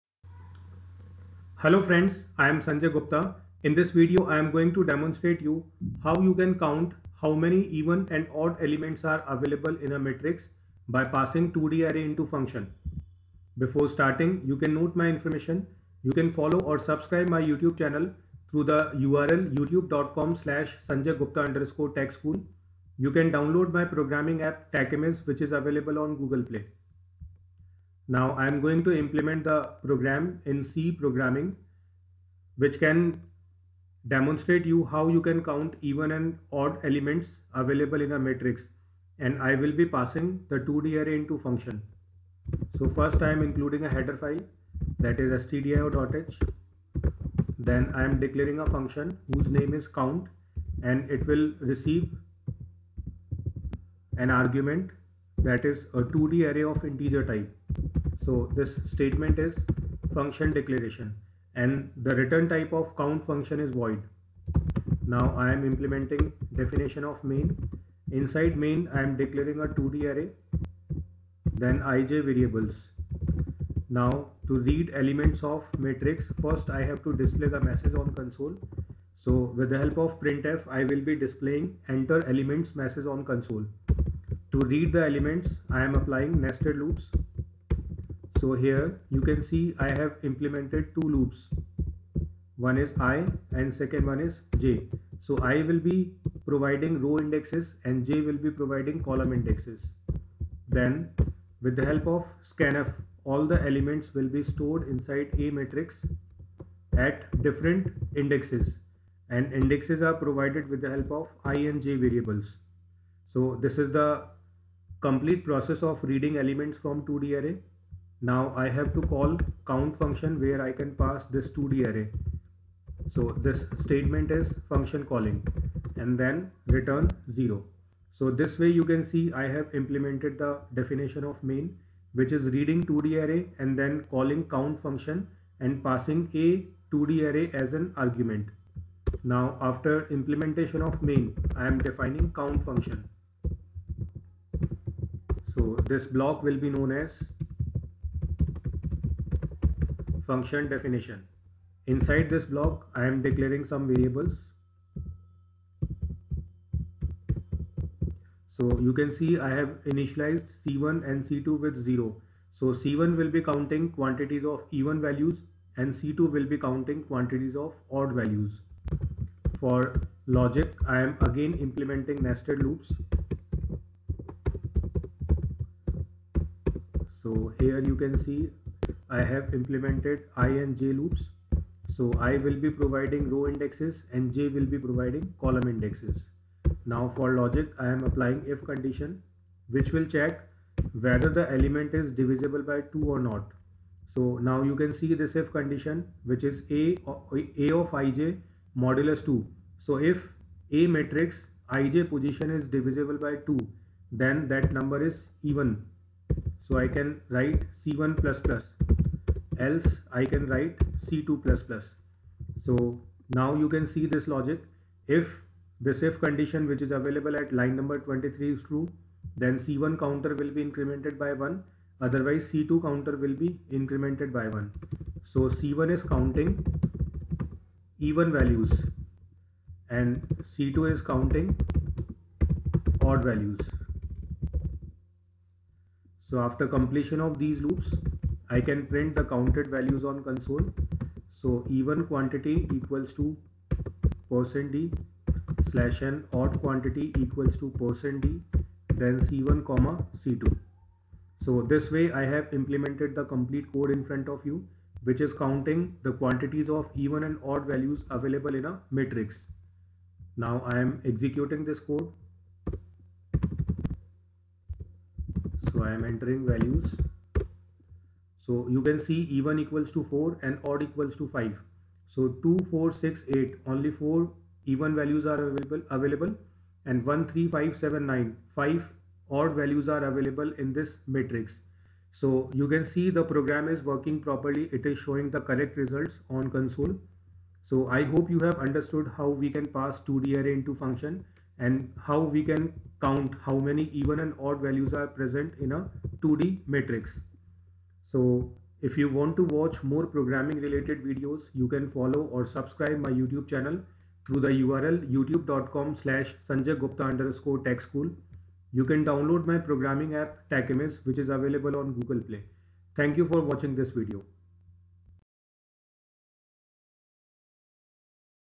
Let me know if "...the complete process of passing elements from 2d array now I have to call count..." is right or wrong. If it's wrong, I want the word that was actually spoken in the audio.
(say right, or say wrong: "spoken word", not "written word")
wrong: "reading", not "passing".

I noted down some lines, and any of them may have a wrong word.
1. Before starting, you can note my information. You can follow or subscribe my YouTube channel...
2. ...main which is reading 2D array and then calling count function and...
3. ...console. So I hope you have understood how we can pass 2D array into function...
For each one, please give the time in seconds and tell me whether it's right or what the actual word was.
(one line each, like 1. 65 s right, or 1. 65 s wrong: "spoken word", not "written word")
1. 13 s right
2. 131 s right
3. 286 s right.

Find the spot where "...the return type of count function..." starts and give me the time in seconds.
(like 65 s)
62 s.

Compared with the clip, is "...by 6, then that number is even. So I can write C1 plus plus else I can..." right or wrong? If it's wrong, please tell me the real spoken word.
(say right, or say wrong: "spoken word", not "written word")
wrong: "2", not "6".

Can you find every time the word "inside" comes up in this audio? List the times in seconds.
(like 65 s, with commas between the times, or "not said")
68 s, 104 s, 151 s.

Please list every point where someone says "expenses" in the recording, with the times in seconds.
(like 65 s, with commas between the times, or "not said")
not said.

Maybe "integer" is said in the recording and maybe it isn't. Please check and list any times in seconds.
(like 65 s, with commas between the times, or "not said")
56 s.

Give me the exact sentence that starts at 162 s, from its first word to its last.
So C1 will be counting quantities of even values and C2 will be counting quantities of odd values.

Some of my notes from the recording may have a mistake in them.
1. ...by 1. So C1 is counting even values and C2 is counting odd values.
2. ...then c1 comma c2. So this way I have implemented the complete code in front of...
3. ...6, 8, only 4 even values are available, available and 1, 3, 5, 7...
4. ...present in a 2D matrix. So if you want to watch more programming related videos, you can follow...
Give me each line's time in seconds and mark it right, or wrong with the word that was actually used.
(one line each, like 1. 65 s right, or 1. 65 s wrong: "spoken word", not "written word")
1. 224 s right
2. 249 s right
3. 272 s right
4. 295 s right.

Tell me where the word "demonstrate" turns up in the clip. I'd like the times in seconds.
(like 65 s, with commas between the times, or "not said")
4 s, 34 s.